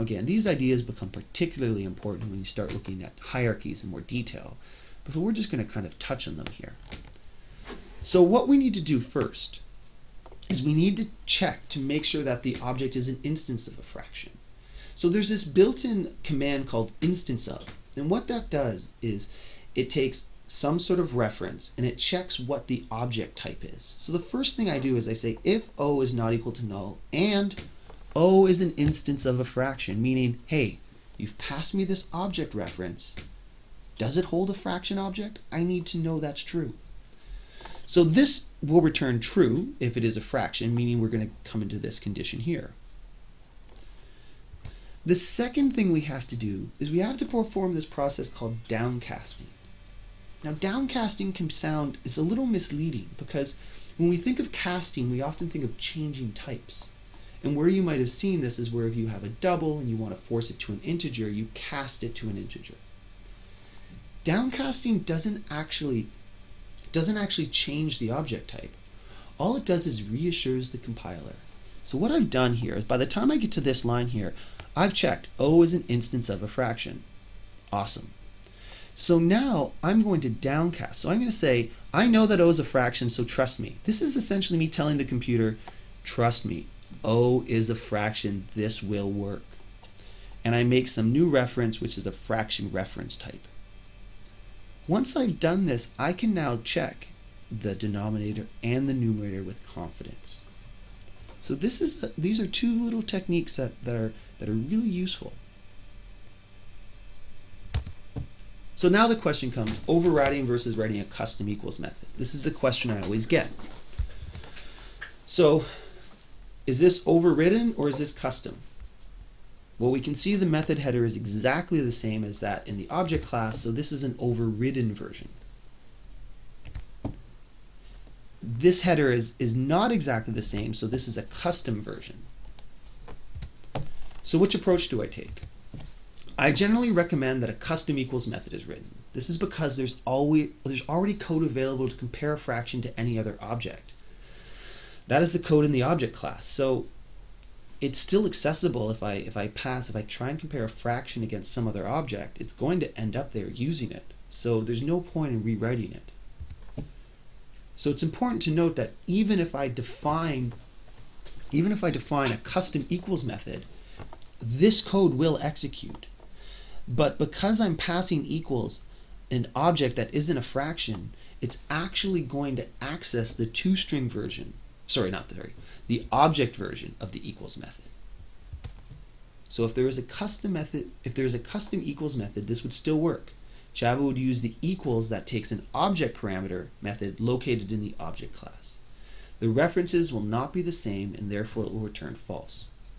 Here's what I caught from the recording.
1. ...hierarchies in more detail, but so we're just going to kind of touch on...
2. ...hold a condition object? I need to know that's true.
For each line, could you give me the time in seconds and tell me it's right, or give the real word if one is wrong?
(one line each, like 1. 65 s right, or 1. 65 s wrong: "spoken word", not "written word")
1. 3 s right
2. 34 s wrong: "fraction", not "condition".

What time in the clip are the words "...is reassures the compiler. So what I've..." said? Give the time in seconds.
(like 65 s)
69 s.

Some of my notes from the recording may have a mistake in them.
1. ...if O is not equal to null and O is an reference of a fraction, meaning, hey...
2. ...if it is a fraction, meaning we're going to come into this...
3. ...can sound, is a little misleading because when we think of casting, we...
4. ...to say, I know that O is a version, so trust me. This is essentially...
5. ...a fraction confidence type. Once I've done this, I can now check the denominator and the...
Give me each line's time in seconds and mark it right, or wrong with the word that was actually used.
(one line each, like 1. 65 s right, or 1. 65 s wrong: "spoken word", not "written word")
1. 25 s wrong: "instance", not "reference"
2. 39 s right
3. 51 s right
4. 81 s wrong: "fraction", not "version"
5. 92 s wrong: "reference", not "confidence".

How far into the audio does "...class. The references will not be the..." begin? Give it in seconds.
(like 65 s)
188 s.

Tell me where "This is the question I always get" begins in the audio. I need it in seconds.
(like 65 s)
112 s.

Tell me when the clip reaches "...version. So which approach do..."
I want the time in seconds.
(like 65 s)
131 s.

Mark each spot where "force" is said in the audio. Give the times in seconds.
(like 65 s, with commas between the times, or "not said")
60 s.